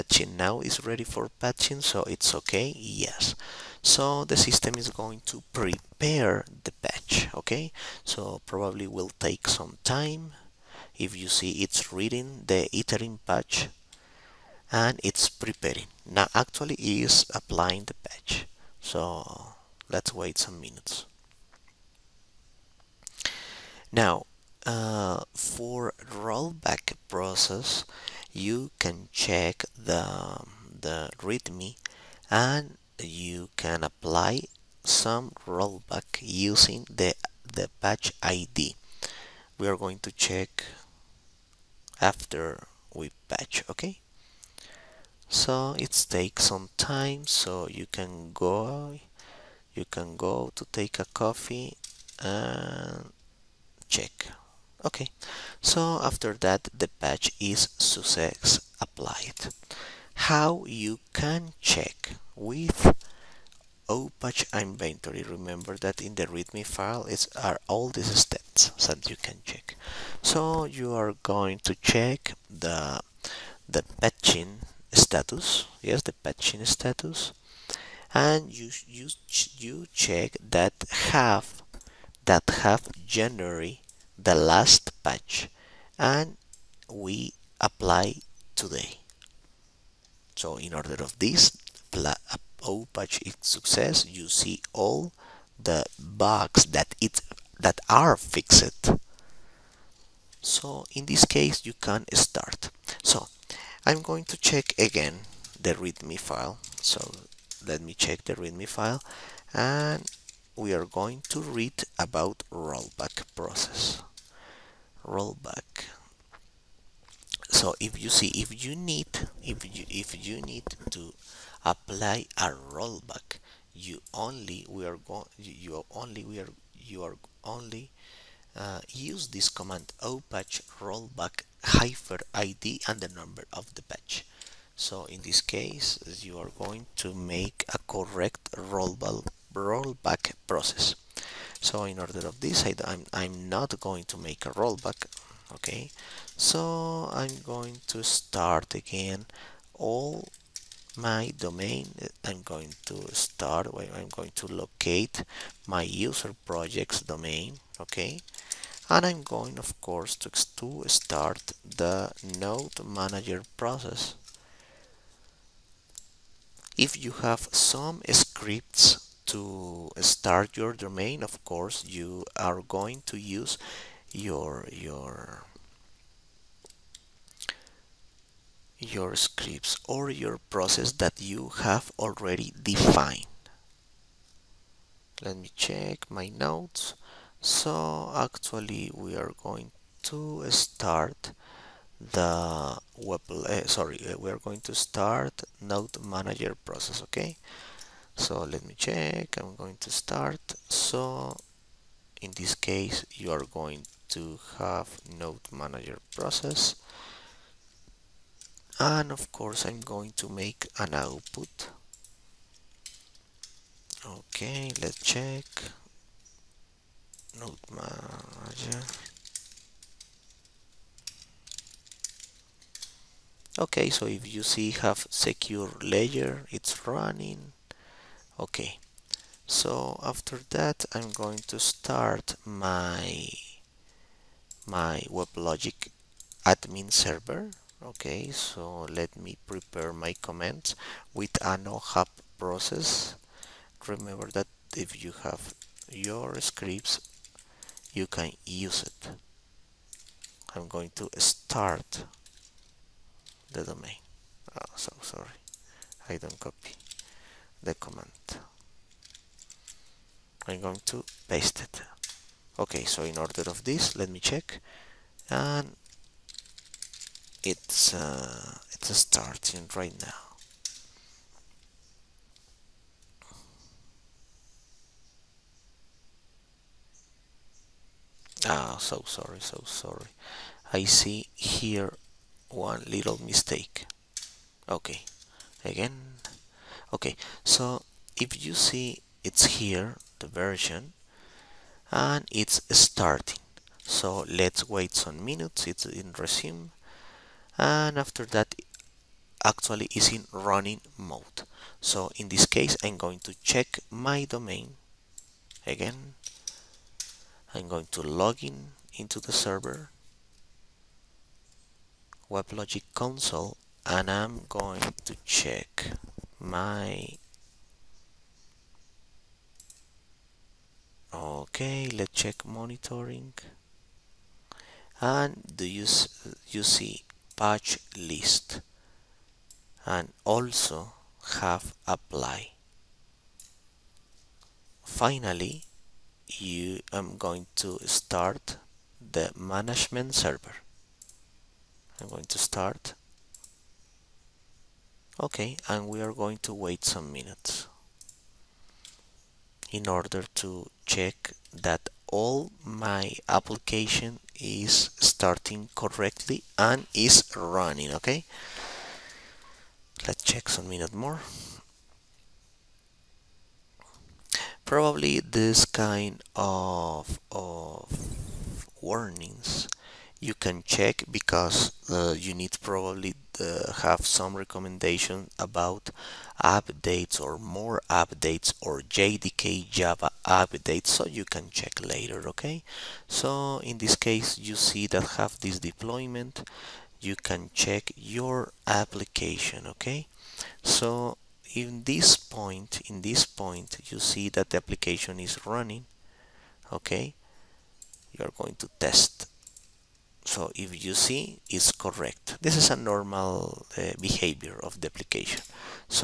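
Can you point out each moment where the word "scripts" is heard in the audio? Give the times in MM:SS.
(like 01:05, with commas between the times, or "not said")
02:48, 02:59, 04:06.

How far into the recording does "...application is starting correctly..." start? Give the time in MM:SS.
05:53.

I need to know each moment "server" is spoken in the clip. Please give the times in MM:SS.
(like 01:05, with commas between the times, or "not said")
03:56, 05:09, 05:40.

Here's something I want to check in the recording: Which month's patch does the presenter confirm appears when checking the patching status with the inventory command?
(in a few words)
January.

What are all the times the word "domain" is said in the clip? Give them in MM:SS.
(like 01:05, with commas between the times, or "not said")
02:31, 02:37, 02:50, 04:13, 05:04.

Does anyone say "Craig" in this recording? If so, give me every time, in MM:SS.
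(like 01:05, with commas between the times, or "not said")
not said.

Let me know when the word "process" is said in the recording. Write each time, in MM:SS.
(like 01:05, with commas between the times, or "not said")
00:27, 01:53, 02:20, 02:43, 03:00, 03:16, 03:26, 04:02.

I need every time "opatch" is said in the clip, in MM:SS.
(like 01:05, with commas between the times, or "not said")
01:03, 02:10.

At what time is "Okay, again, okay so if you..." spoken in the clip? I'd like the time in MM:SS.
04:44.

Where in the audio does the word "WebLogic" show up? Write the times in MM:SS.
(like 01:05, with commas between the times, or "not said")
03:55, 05:12.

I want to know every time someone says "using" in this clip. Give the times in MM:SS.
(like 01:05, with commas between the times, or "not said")
00:36.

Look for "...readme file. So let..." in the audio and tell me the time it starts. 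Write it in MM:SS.
01:45.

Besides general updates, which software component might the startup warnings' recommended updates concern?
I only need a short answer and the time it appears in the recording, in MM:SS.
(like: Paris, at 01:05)
JDK Java, at 06:18.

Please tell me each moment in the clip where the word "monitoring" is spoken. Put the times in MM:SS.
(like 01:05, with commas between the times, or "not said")
05:22.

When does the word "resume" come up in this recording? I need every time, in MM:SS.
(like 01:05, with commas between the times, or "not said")
04:56.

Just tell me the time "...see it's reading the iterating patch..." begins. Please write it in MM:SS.
00:11.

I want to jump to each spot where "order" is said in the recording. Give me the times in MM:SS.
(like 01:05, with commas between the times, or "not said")
01:30, 02:21, 04:23, 05:49.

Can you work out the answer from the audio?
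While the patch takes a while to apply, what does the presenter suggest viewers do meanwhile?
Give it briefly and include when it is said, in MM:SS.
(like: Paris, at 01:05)
take a coffee, at 00:50.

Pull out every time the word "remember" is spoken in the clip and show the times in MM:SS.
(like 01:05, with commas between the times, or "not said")
01:05, 04:03.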